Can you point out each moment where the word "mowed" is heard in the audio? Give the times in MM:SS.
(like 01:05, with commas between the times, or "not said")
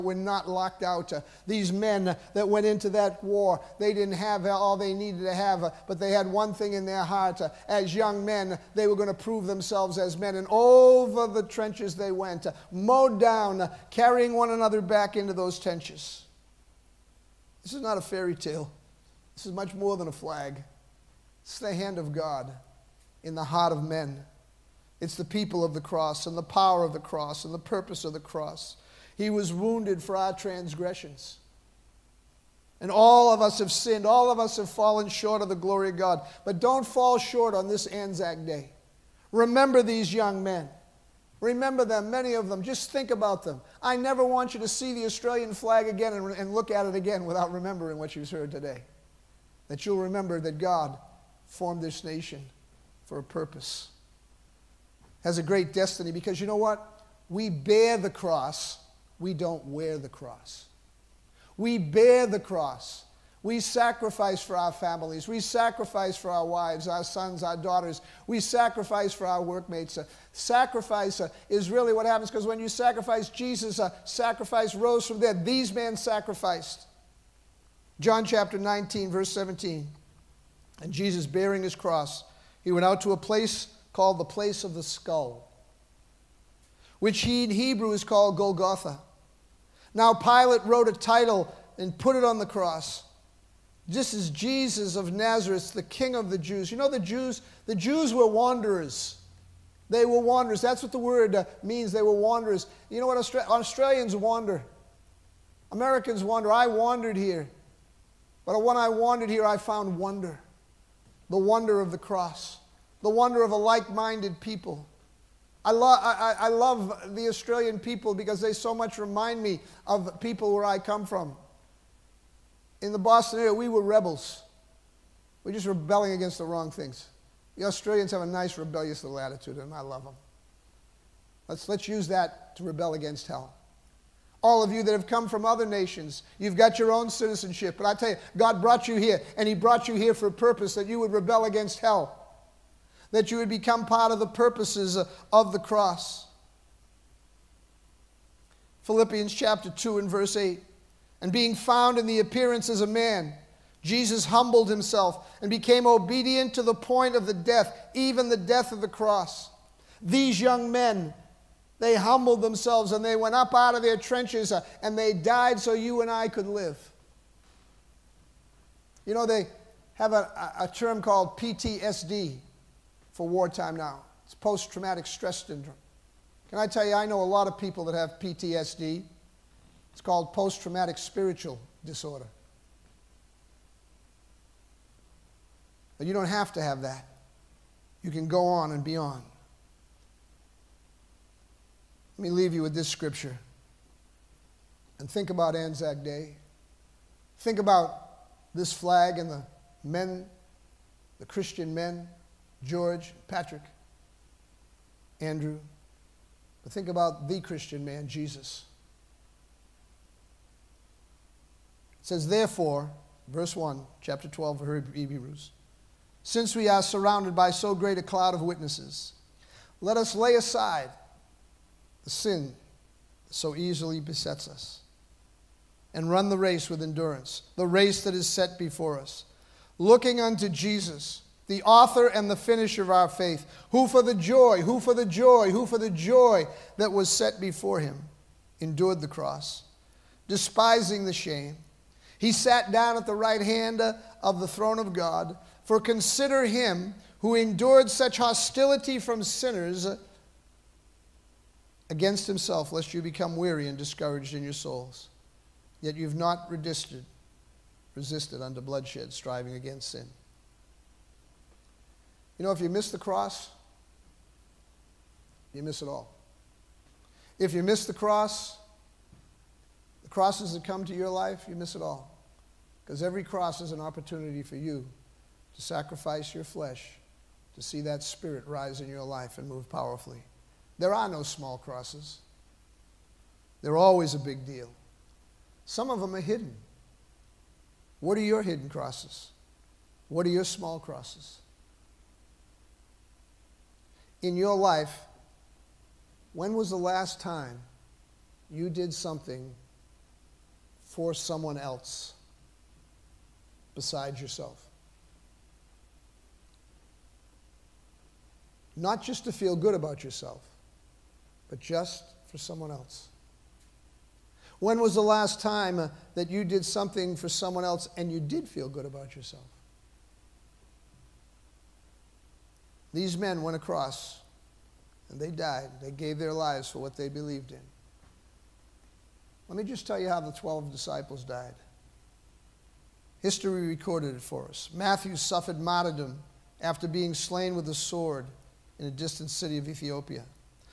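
00:12.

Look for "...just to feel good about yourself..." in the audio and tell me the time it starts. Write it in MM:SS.
05:09.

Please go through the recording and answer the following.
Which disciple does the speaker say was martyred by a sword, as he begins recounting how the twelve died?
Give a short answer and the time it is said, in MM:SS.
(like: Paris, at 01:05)
Matthew, at 05:34.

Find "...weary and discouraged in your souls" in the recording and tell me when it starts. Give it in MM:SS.
04:13.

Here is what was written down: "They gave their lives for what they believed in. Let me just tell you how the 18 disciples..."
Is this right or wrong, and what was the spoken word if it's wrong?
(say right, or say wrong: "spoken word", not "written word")
wrong: "12", not "18".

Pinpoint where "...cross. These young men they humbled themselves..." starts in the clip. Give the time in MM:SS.
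02:38.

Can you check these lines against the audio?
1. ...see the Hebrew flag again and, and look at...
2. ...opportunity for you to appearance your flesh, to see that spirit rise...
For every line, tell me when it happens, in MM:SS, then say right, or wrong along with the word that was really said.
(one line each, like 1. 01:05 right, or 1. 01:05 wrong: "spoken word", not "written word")
1. 00:44 wrong: "Australian", not "Hebrew"
2. 04:33 wrong: "sacrifice", not "appearance".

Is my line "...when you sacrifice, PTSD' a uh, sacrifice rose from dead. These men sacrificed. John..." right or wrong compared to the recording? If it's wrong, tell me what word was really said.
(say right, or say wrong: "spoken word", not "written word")
wrong: "Jesus", not "PTSD".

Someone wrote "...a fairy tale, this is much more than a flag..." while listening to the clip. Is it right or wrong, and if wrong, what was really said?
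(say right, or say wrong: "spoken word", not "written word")
right.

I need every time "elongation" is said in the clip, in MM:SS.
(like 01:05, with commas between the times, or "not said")
not said.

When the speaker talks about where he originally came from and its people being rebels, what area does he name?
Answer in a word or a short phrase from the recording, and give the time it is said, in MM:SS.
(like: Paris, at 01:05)
Boston, at 02:02.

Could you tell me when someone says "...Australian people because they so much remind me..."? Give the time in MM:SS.
01:57.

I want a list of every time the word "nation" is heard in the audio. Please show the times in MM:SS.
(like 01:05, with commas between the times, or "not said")
00:52, 02:15.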